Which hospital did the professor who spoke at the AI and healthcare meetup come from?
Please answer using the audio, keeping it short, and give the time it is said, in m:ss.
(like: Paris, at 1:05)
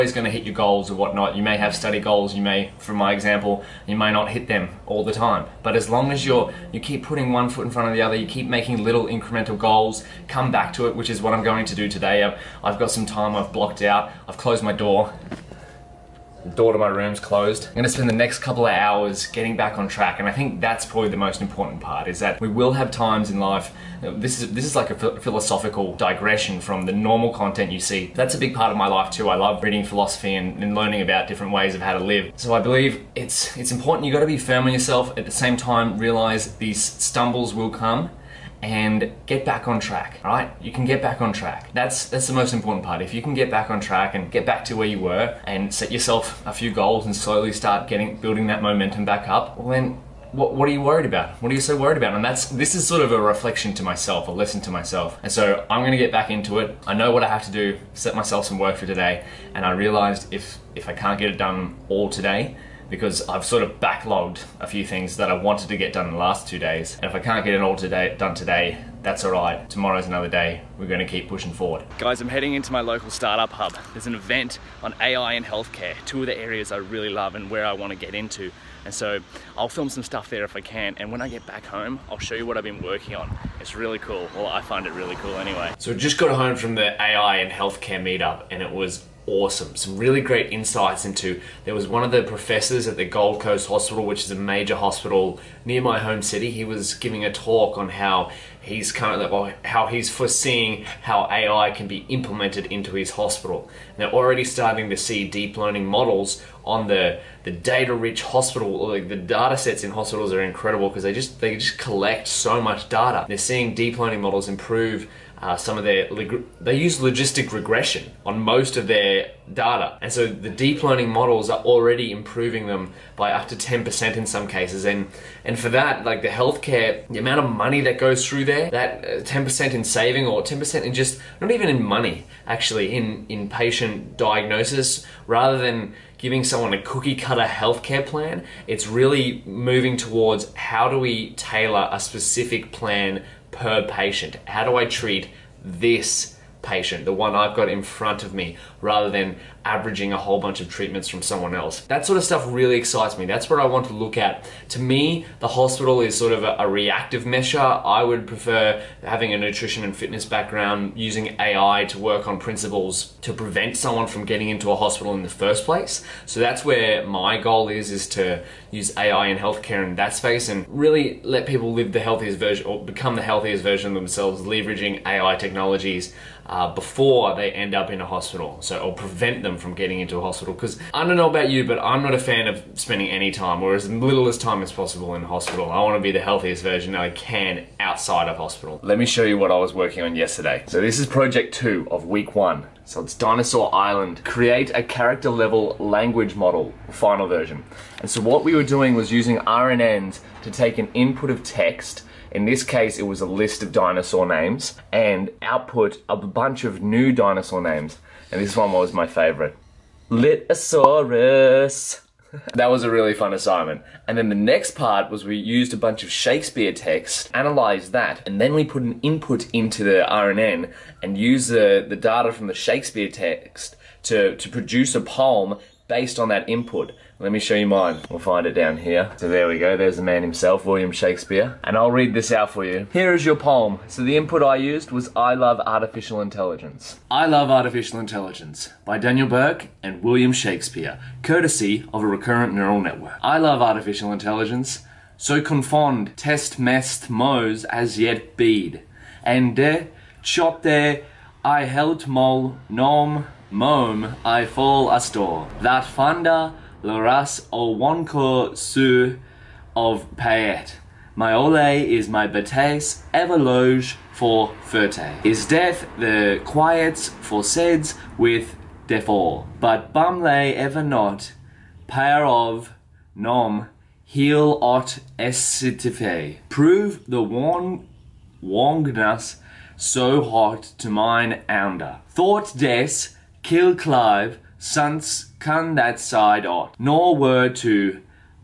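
Gold Coast Hospital, at 1:33.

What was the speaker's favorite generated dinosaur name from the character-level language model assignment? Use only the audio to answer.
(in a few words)
Litosaurus.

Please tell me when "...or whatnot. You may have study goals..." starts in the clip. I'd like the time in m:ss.
0:00.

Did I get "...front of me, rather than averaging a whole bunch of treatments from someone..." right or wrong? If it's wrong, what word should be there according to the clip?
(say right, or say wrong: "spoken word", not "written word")
right.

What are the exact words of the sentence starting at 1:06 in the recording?
And if I can't get it all today, done today, that's all right.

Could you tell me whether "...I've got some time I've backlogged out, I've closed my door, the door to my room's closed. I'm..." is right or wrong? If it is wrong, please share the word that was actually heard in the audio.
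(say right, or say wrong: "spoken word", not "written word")
wrong: "blocked", not "backlogged".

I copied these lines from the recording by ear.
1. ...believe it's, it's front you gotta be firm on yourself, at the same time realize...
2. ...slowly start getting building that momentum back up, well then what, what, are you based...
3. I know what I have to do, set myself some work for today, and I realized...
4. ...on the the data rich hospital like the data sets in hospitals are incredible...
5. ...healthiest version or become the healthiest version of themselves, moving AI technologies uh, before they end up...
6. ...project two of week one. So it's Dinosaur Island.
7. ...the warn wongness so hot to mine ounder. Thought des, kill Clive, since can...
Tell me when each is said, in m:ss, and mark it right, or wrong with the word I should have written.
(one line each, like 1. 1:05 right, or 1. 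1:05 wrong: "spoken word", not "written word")
1. 0:32 wrong: "important", not "front"
2. 0:47 wrong: "worried", not "based"
3. 0:56 right
4. 1:46 right
5. 2:51 wrong: "leveraging", not "moving"
6. 3:11 right
7. 4:37 right.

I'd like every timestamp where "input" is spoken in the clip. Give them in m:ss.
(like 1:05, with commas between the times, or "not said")
3:20, 3:39, 3:46, 3:54.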